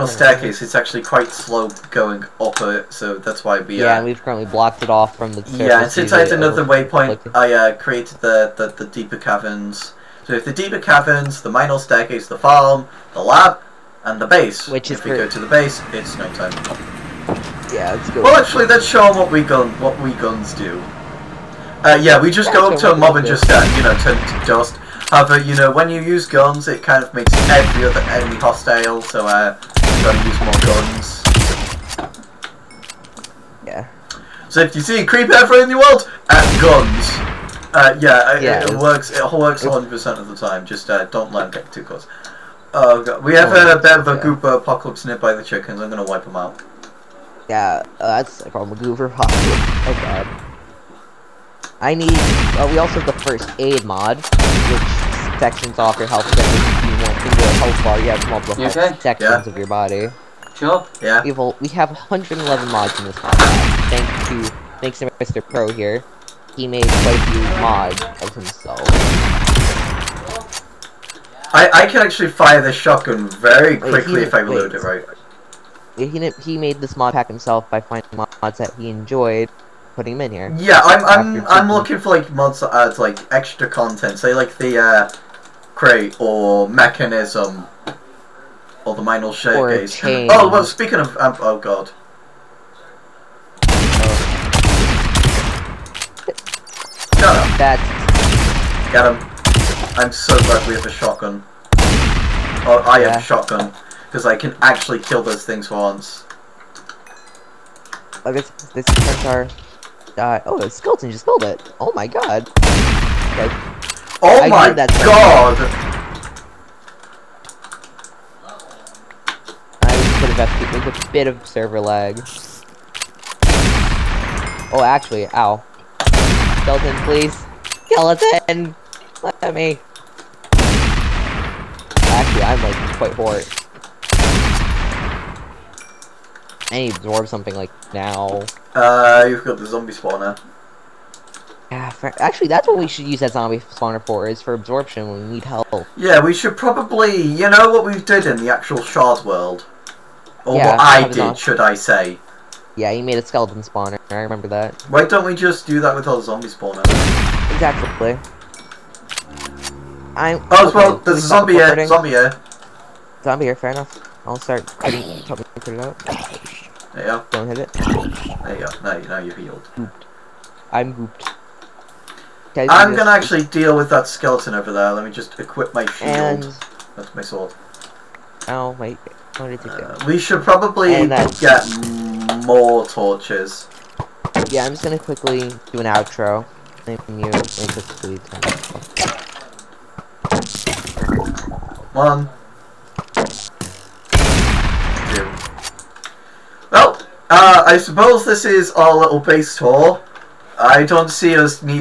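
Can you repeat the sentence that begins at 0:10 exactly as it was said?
So if the deeper caverns, the minor staircase, the farm, the lab, and the base.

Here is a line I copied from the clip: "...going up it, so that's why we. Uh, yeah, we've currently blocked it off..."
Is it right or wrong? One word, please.
right.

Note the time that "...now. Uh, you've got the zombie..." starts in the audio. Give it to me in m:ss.
2:17.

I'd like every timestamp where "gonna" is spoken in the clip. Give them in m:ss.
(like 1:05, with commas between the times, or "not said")
0:45, 2:52, 3:04.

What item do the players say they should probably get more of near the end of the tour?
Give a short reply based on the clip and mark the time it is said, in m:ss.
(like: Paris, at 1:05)
torches, at 3:02.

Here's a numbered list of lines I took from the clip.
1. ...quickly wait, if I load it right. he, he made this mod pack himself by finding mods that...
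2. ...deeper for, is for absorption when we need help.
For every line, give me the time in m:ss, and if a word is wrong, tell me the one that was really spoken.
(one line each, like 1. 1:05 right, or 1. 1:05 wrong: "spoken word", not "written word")
1. 1:13 right
2. 2:23 wrong: "spawner", not "deeper".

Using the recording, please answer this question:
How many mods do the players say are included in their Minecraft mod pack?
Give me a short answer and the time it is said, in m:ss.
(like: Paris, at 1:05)
111, at 1:01.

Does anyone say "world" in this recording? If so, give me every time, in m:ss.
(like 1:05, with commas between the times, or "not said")
0:35, 2:29.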